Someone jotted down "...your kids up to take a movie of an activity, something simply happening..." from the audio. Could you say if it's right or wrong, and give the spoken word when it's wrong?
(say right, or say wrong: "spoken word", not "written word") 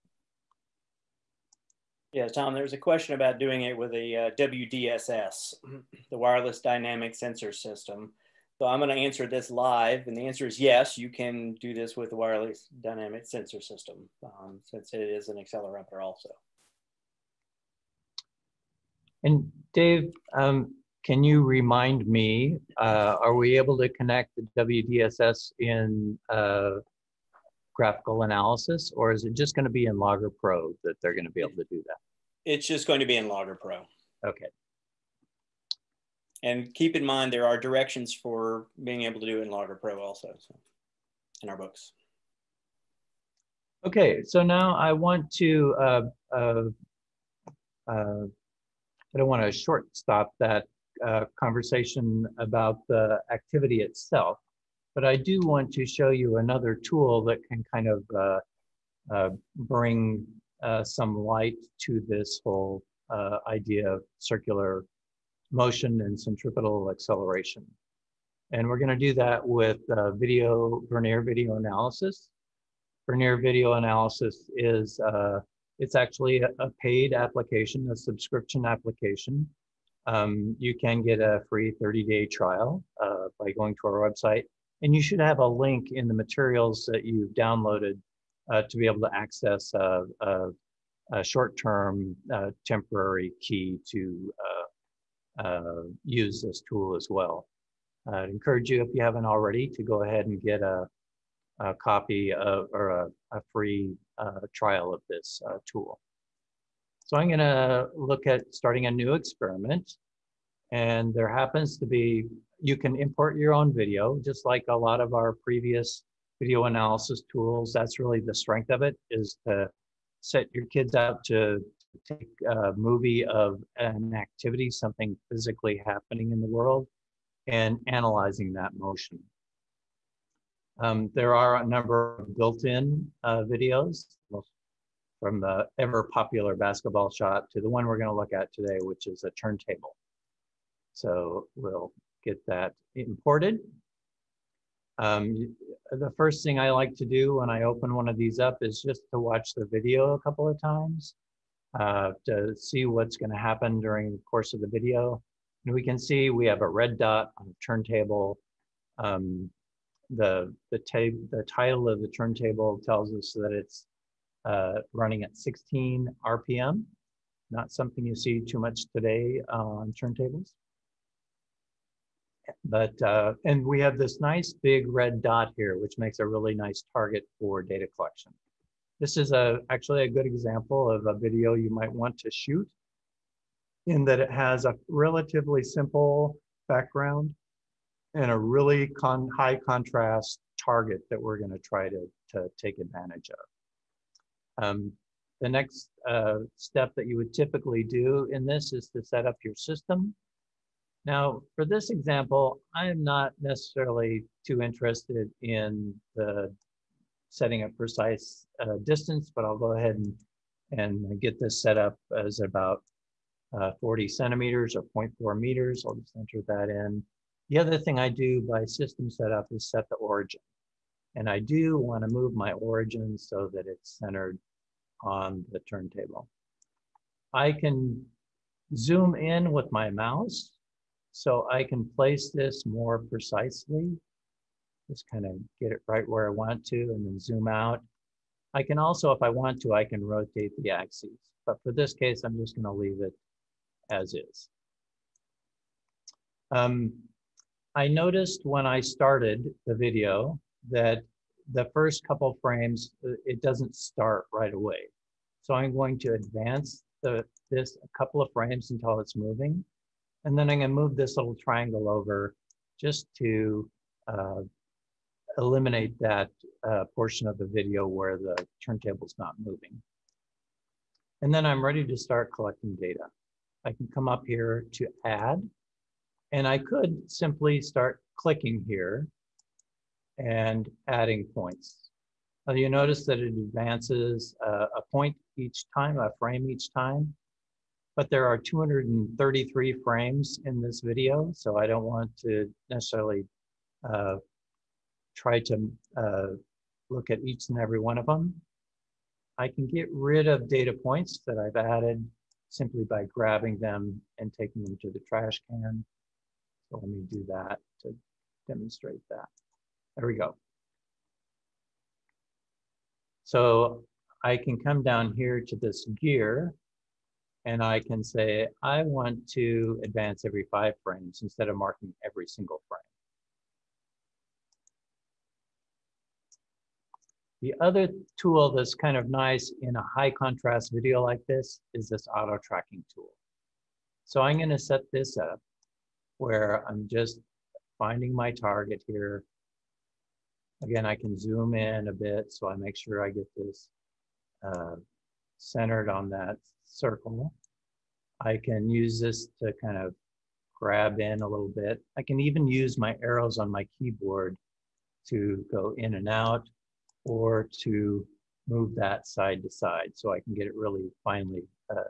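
wrong: "physically", not "simply".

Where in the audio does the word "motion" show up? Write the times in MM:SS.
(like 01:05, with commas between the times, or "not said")
01:05, 02:08.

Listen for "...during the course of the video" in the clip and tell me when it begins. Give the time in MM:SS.
02:33.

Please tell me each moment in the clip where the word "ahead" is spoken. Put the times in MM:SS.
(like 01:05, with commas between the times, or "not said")
01:40, 03:29.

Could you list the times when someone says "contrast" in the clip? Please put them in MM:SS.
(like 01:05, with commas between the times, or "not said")
03:09, 05:30.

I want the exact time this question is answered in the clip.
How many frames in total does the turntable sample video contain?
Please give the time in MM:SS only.
04:48.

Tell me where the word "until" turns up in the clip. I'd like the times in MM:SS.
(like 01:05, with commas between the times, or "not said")
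04:18.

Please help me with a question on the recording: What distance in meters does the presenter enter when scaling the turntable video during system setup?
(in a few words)
0.4 meters.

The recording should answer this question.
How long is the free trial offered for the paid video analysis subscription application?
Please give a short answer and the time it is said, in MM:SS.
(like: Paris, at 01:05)
30 days, at 01:21.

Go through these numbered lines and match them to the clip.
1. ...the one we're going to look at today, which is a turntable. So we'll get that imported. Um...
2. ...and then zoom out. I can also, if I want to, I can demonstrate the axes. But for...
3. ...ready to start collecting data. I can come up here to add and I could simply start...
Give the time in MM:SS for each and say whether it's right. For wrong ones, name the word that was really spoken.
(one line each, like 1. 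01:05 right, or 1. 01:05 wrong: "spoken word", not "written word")
1. 02:17 right
2. 03:56 wrong: "rotate", not "demonstrate"
3. 04:31 right.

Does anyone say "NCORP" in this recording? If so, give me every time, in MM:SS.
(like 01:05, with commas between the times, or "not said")
not said.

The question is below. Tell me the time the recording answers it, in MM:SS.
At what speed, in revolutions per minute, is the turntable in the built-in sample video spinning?
02:45.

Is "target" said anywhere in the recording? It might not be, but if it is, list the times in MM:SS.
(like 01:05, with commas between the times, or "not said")
02:56, 03:10, 05:38.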